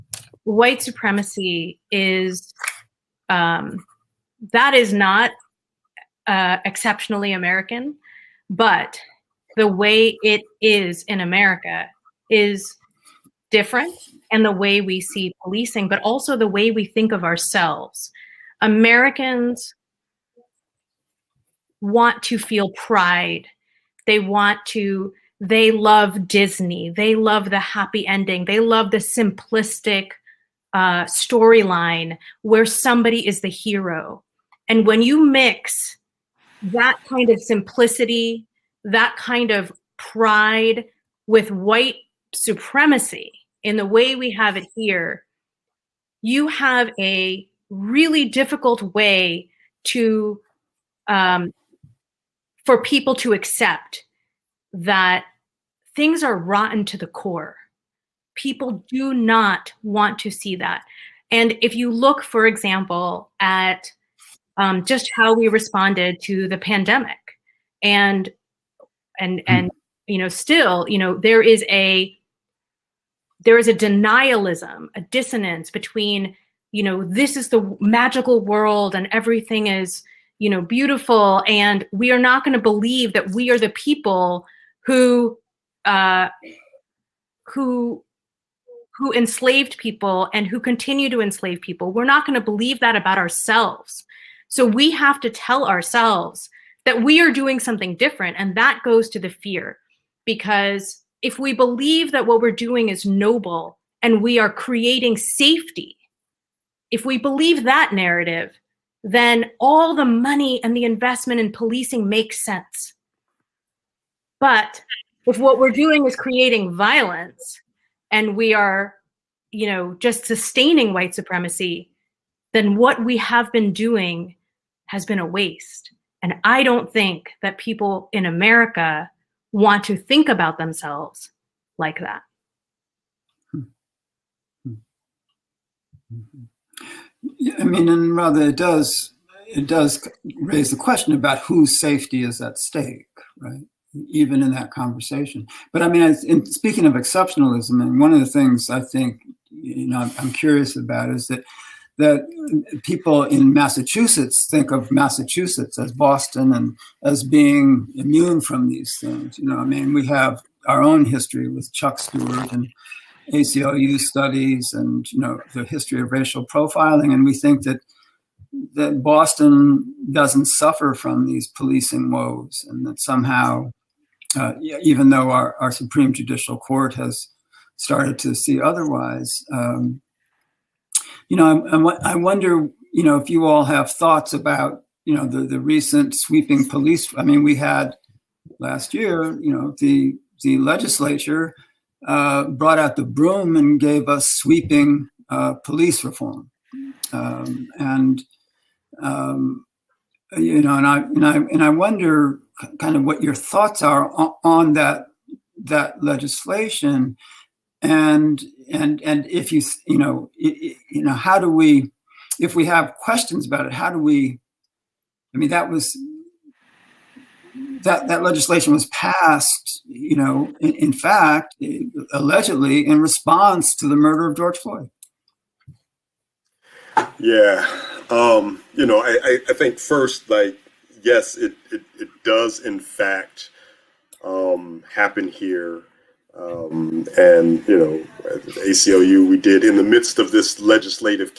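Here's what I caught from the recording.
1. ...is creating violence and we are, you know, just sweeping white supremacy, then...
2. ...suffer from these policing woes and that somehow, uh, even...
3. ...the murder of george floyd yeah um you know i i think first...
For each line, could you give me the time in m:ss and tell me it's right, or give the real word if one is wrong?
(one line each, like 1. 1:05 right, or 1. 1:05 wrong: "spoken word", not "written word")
1. 1:56 wrong: "sustaining", not "sweeping"
2. 2:50 right
3. 3:43 right.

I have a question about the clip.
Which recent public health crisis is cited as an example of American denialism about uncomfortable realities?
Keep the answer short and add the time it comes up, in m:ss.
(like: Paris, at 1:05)
the pandemic, at 1:06.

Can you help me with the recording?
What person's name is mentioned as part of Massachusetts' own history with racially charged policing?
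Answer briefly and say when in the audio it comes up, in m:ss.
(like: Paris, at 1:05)
Chuck Stuart, at 2:41.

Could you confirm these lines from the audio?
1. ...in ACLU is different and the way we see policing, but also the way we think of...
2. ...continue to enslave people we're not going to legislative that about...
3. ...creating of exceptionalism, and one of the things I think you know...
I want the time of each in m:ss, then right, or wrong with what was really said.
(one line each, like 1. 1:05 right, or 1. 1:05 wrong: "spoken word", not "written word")
1. 0:11 wrong: "America", not "ACLU"
2. 1:30 wrong: "believe", not "legislative"
3. 2:26 wrong: "speaking", not "creating".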